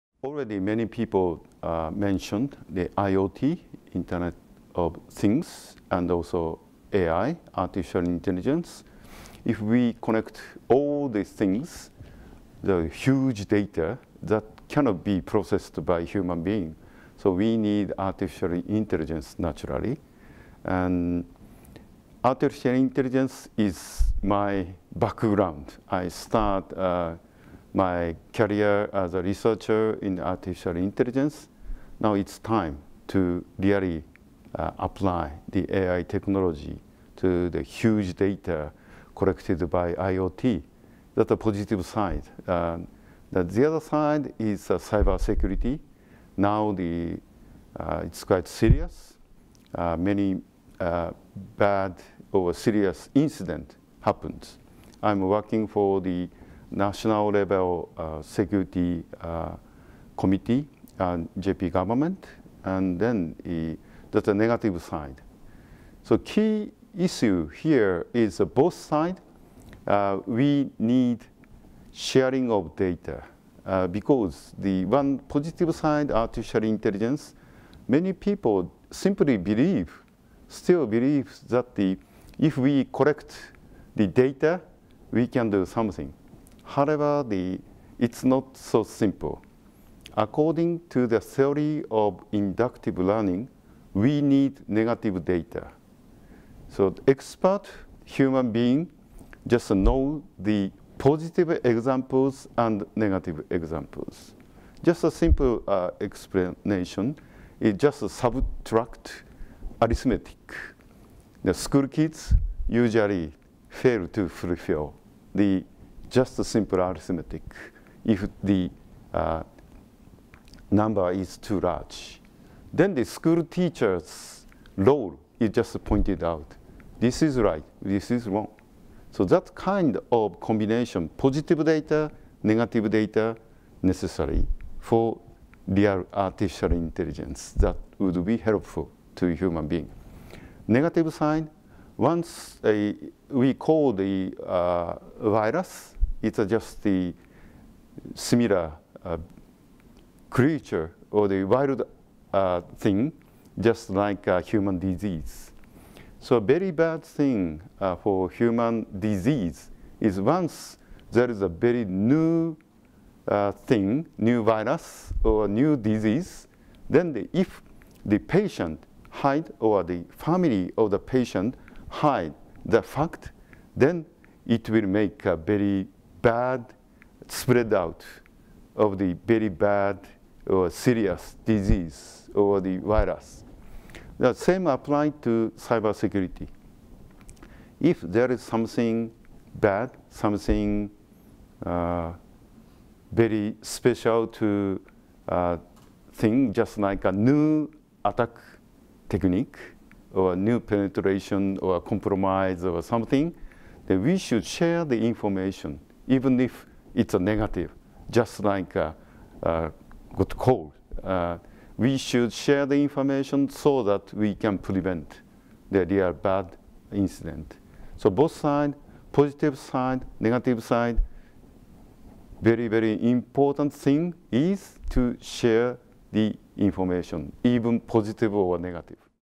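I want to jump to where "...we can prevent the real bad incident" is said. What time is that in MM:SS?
03:34.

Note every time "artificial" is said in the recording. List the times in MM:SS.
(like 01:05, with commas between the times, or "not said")
00:07, 00:17, 00:22, 00:30, 01:16, 02:16.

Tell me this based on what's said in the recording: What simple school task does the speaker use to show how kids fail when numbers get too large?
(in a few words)
subtract arithmetic.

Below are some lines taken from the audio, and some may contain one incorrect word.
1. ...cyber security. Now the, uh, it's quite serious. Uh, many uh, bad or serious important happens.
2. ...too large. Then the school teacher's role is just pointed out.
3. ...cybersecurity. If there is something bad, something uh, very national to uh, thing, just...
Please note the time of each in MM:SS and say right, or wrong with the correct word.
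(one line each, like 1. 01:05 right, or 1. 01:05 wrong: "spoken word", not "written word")
1. 00:44 wrong: "incident", not "important"
2. 02:01 right
3. 03:05 wrong: "special", not "national".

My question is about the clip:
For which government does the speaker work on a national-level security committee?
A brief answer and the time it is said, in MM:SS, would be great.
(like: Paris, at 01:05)
JP government, at 01:01.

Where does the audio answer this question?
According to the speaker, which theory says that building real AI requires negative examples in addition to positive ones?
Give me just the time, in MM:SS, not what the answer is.
01:32.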